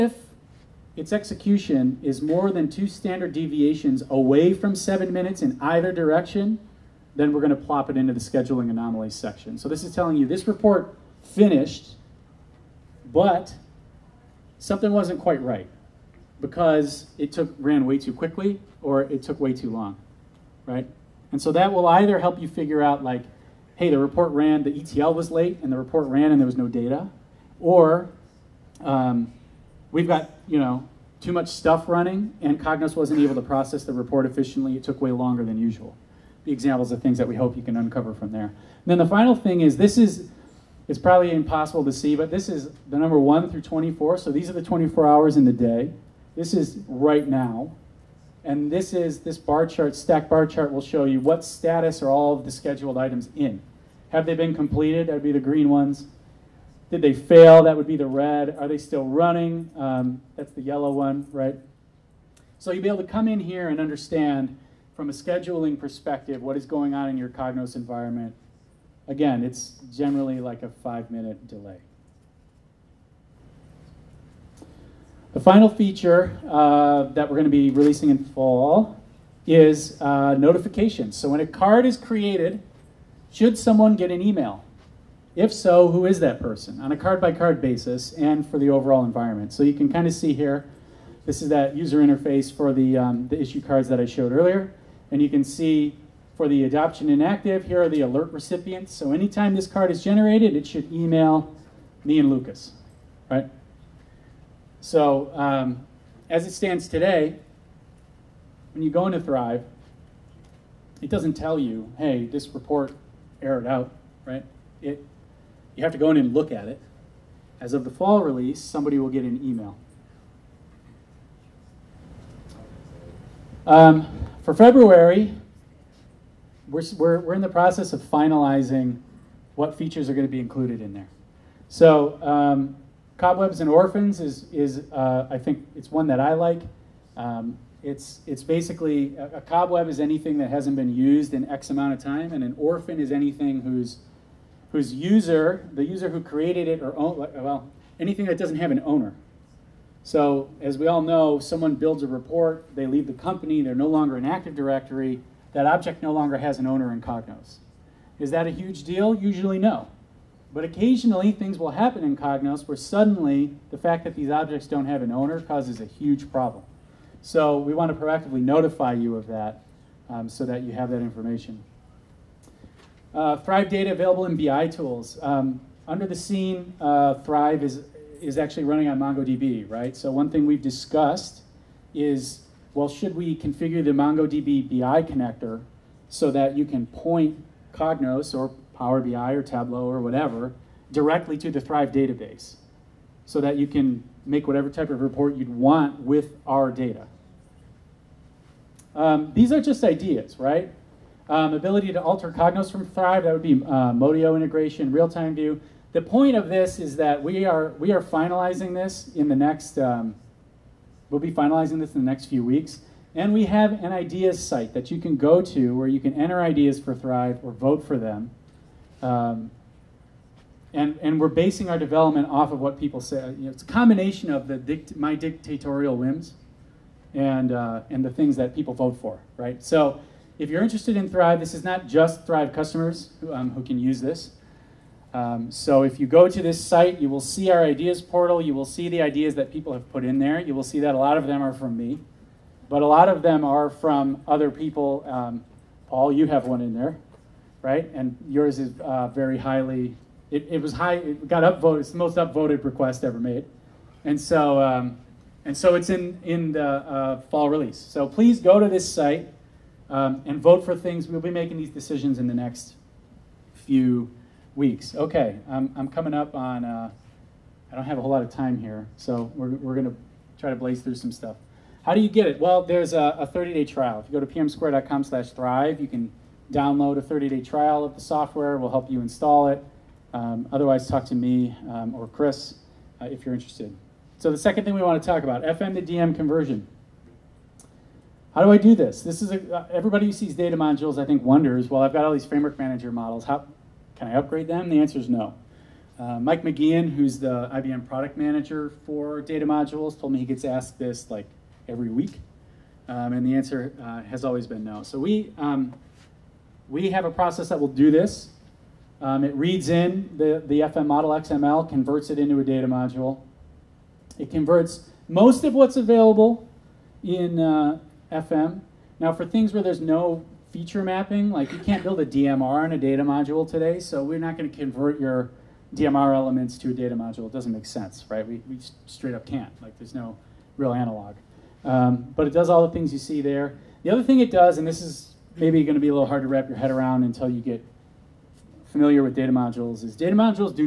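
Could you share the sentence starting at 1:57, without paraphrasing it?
As of the fall release, somebody will get an email.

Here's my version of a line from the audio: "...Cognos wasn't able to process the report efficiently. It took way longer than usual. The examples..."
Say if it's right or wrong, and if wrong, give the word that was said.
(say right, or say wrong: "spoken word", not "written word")
right.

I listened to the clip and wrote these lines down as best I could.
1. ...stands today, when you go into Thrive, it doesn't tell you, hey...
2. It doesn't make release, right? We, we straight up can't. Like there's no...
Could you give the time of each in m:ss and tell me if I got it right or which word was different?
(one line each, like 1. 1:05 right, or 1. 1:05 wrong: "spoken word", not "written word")
1. 1:46 right
2. 5:27 wrong: "sense", not "release".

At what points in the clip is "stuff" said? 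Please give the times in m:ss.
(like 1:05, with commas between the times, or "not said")
0:31, 4:31.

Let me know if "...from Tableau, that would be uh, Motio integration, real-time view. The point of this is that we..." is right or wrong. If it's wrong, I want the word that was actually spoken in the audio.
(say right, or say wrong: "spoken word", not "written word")
wrong: "Thrive", not "Tableau".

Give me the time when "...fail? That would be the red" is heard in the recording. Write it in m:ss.
0:57.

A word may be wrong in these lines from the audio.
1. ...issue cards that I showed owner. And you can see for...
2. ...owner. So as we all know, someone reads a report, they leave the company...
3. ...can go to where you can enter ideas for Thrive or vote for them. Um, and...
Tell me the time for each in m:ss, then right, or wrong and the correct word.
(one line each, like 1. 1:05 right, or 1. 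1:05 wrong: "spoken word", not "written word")
1. 1:33 wrong: "earlier", not "owner"
2. 2:28 wrong: "builds", not "reads"
3. 3:34 right.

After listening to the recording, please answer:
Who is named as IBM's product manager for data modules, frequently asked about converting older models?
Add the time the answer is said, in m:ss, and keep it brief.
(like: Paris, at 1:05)
Mike McGeehan, at 4:56.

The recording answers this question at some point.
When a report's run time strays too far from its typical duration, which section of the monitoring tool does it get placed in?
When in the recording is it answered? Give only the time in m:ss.
0:08.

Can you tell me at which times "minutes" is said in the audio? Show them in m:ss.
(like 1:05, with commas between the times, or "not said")
0:05, 1:11.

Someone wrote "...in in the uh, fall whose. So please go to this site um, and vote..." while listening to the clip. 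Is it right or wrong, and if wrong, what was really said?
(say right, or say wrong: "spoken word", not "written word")
wrong: "release", not "whose".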